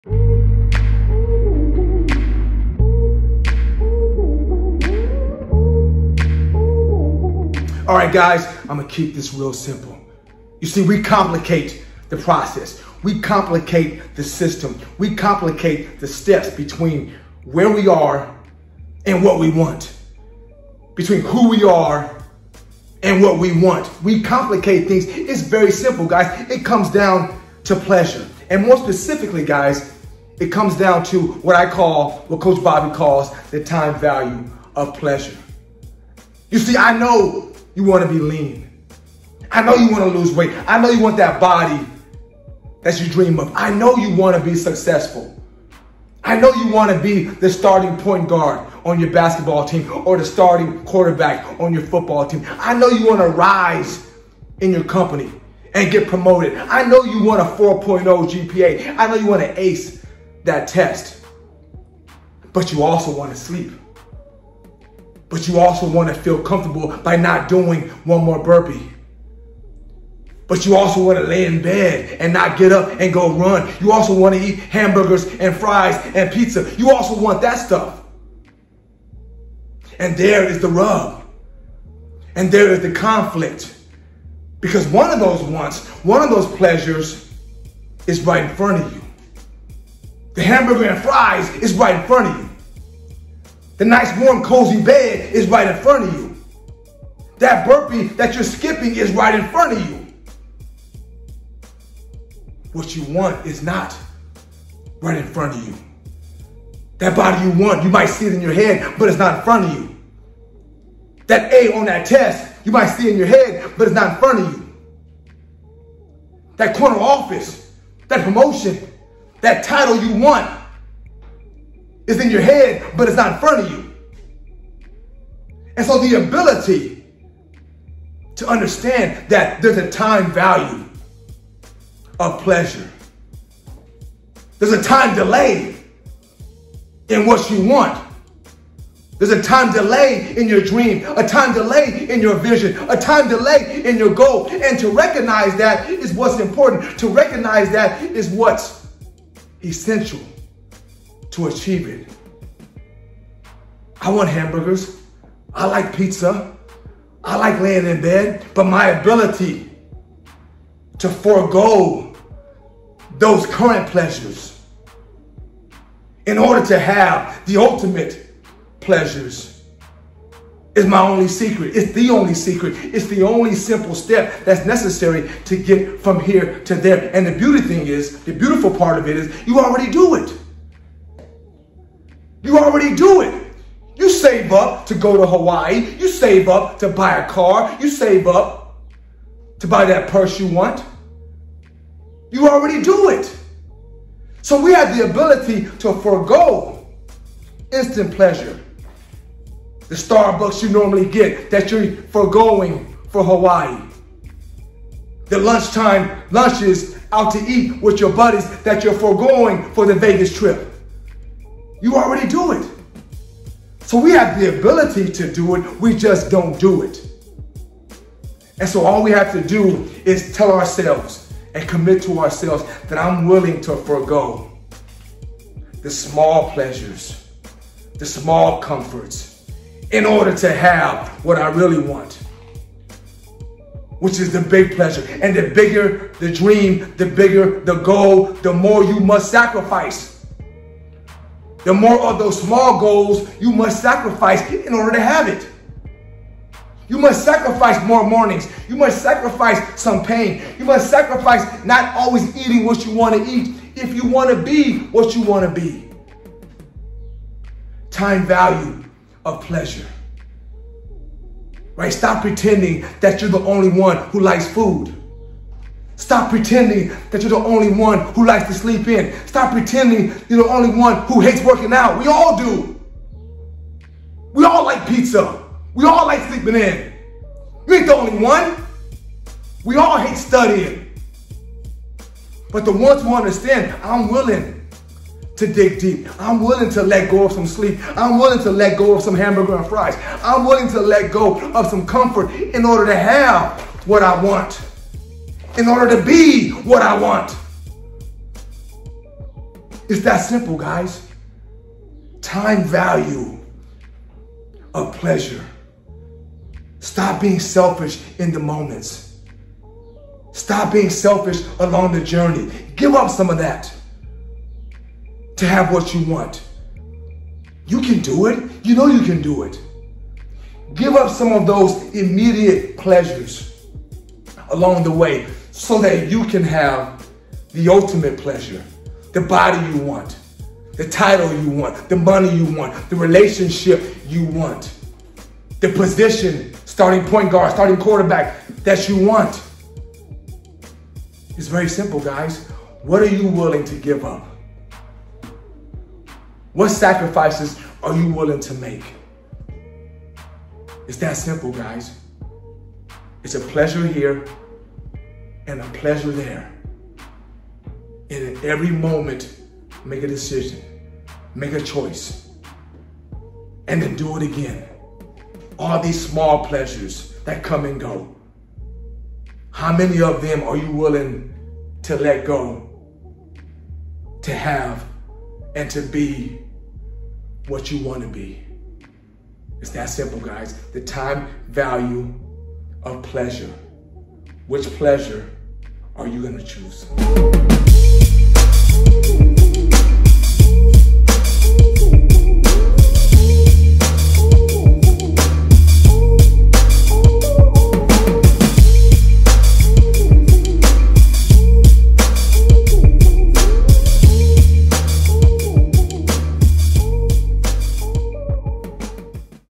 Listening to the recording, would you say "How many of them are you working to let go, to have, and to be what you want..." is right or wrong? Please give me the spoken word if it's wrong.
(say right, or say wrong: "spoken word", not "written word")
wrong: "willing", not "working".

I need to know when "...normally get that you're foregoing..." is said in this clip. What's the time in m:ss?
3:20.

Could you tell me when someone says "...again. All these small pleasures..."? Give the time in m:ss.
6:04.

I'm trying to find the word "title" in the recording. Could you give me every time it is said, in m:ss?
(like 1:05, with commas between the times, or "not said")
1:59, 5:30.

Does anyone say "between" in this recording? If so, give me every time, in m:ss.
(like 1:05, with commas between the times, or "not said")
0:16, 0:20.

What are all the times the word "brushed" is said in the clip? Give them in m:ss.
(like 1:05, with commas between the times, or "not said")
not said.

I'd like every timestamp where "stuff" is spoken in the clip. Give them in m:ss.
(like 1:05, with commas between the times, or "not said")
1:17.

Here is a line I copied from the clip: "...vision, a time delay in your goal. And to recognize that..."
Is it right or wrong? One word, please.
right.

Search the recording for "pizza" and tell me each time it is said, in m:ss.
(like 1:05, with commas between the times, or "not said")
1:16, 2:35, 4:34.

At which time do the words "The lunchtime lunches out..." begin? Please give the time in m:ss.
3:25.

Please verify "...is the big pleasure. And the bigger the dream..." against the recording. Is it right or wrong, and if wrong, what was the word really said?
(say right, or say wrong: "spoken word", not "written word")
right.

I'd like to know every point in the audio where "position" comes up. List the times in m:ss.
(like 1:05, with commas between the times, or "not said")
5:35.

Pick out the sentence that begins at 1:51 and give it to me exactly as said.
That A on that test, you might see it in your head, but it's not in front of you.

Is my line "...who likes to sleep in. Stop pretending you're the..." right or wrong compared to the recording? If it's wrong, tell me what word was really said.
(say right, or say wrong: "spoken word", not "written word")
right.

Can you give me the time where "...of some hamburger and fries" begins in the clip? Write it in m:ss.
4:48.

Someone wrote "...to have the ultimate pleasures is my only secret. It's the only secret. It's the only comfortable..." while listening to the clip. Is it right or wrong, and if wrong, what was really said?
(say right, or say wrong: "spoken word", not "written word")
wrong: "simple", not "comfortable".